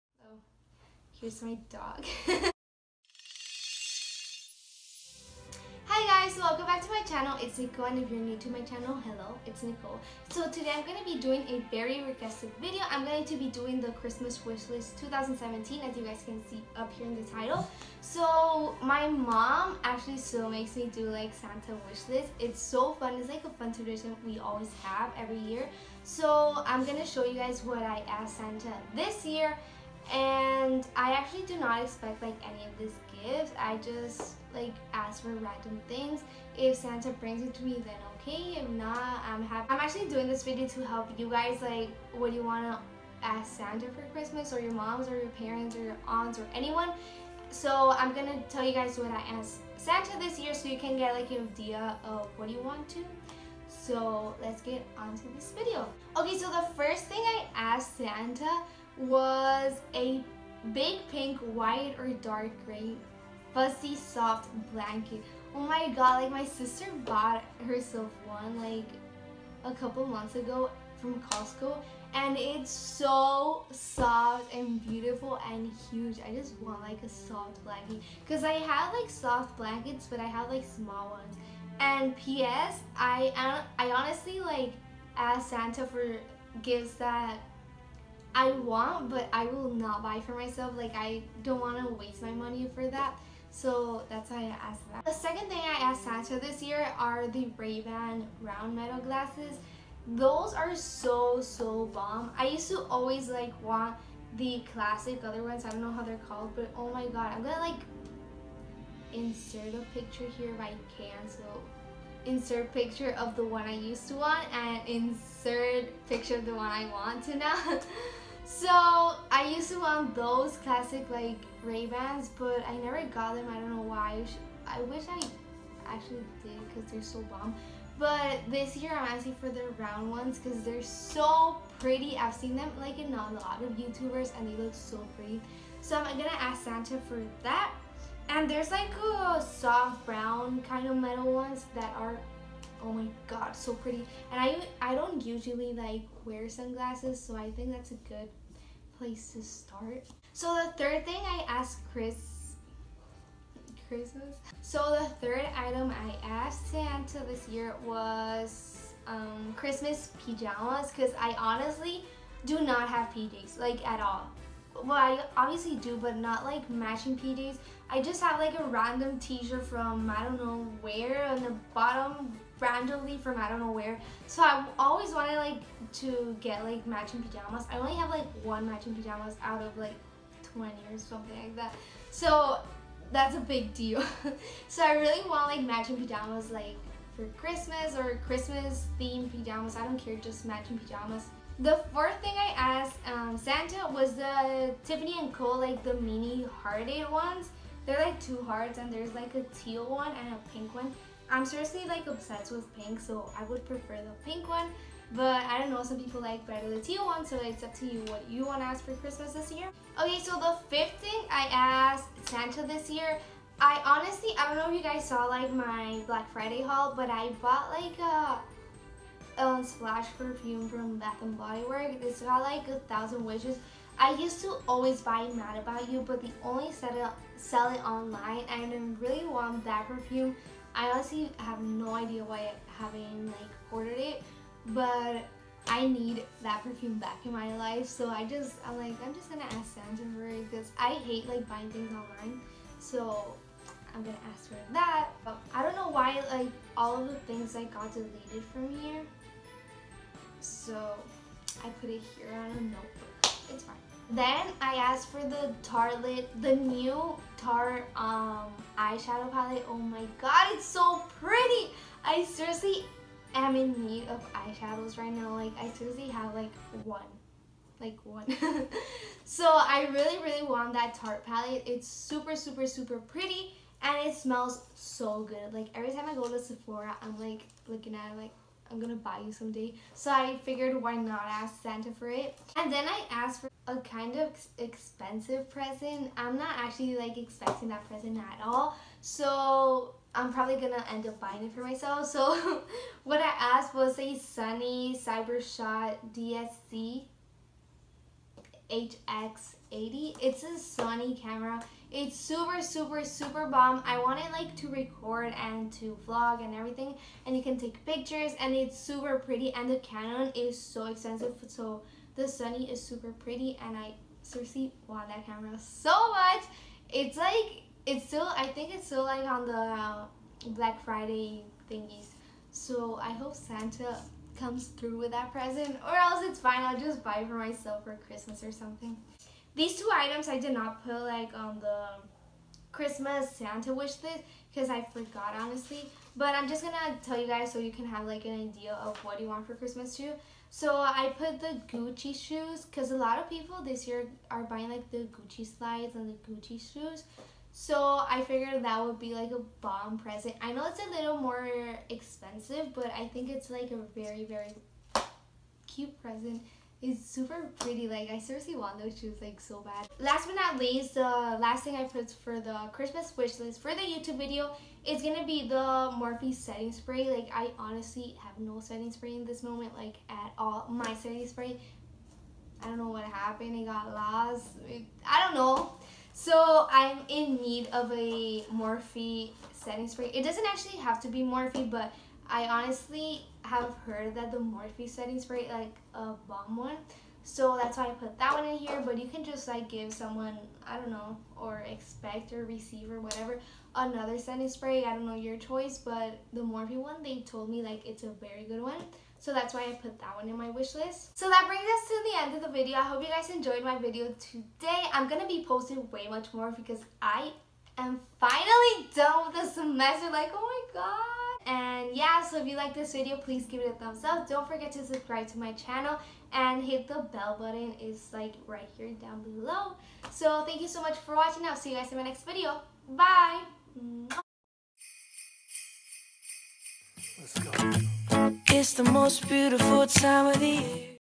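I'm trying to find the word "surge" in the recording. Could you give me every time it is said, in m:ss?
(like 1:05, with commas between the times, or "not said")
not said.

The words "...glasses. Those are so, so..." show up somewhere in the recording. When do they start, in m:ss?
1:38.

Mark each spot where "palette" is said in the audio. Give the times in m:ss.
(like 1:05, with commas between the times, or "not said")
4:19, 4:31.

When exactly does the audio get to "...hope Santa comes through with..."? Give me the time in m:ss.
5:23.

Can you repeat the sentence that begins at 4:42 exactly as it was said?
And then I asked for a kind of expensive present.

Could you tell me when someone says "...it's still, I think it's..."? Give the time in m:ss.
5:17.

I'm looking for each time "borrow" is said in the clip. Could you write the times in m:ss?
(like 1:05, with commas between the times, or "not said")
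not said.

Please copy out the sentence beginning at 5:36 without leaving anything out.
But I'm just gonna tell you guys so you can have like an idea of what you want for Christmas too.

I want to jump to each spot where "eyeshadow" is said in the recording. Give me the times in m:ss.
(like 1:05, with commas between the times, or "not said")
4:18, 4:24.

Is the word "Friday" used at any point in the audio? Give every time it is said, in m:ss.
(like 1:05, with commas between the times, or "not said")
3:36, 5:20.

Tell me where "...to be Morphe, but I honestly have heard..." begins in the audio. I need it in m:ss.
6:21.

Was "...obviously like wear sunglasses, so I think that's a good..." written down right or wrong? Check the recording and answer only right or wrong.
wrong.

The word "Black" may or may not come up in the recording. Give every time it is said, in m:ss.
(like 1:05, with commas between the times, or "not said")
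3:36, 5:20.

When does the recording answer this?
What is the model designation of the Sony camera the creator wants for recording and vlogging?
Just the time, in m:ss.
4:55.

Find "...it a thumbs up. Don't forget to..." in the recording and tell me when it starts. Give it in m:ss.
6:53.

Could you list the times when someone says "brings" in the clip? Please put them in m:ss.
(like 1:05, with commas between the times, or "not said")
0:37, 6:41.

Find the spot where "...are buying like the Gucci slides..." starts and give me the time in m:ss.
5:44.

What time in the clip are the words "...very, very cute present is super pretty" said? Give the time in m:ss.
5:53.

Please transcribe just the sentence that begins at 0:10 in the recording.
So today I'm going to be doing a very requested video.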